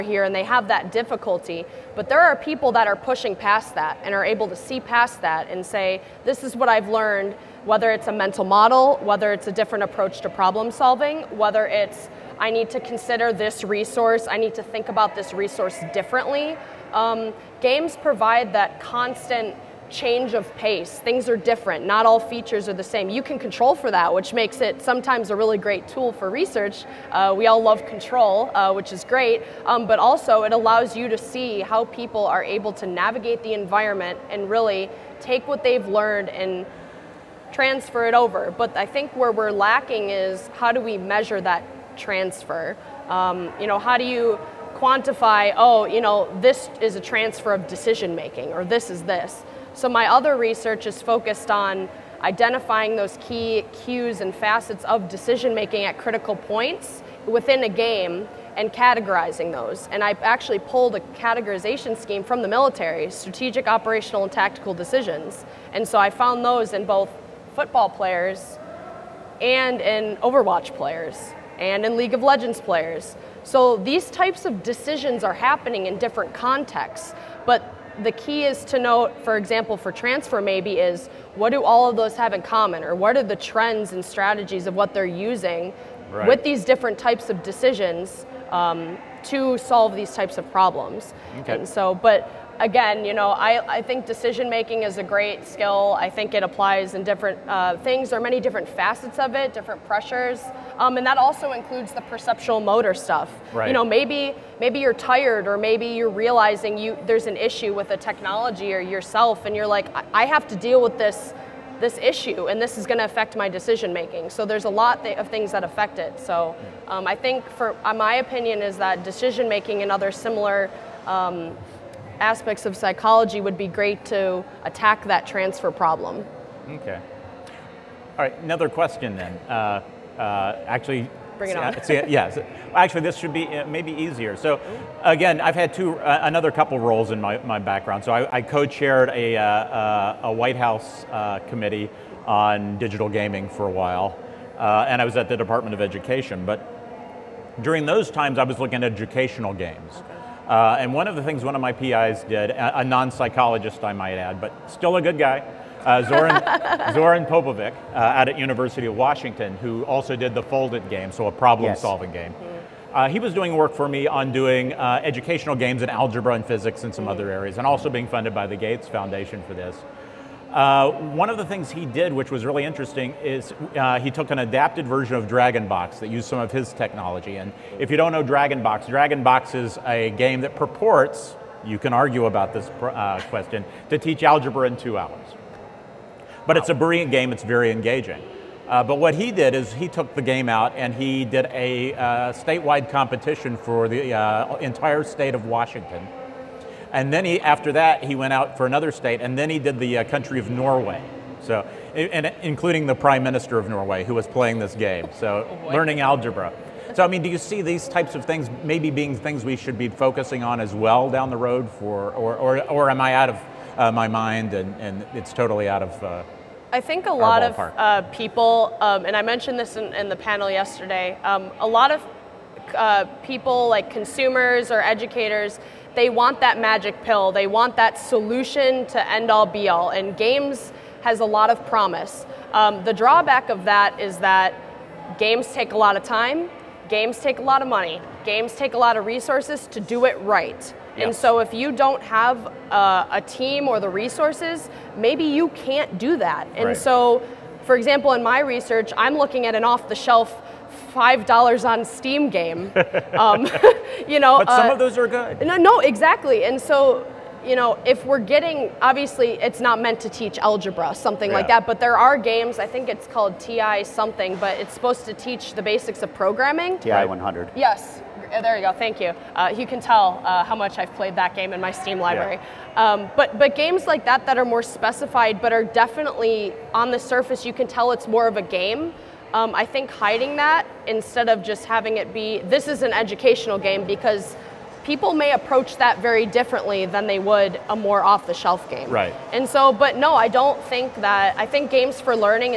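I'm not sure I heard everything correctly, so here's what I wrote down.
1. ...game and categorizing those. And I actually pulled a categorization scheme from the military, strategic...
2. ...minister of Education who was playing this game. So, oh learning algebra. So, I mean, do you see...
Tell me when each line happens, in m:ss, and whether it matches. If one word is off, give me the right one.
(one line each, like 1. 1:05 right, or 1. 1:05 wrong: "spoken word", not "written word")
1. 0:57 right
2. 3:23 wrong: "Norway", not "Education".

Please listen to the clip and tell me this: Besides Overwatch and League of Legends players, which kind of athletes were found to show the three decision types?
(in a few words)
football players.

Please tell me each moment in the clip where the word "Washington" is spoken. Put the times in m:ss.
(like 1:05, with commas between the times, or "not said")
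2:38, 3:15.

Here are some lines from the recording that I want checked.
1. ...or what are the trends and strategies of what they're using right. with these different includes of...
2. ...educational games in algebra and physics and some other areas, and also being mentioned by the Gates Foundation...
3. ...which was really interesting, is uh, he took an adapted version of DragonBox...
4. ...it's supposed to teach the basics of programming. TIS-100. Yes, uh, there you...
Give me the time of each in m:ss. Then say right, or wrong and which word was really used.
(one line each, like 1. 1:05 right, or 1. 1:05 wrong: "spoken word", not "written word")
1. 1:22 wrong: "types", not "includes"
2. 2:45 wrong: "funded", not "mentioned"
3. 2:52 right
4. 4:24 right.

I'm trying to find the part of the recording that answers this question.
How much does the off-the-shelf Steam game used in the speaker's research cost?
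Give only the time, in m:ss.
4:10.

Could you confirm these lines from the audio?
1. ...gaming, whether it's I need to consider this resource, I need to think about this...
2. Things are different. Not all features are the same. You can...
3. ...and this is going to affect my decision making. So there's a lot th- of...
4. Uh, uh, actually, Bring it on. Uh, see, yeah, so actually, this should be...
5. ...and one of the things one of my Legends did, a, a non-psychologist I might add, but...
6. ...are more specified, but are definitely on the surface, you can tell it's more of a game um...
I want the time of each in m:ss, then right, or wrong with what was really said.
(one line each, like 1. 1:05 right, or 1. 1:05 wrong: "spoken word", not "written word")
1. 0:10 wrong: "solving", not "gaming"
2. 0:20 right
3. 1:52 right
4. 2:09 right
5. 2:30 wrong: "PIs", not "Legends"
6. 4:34 right.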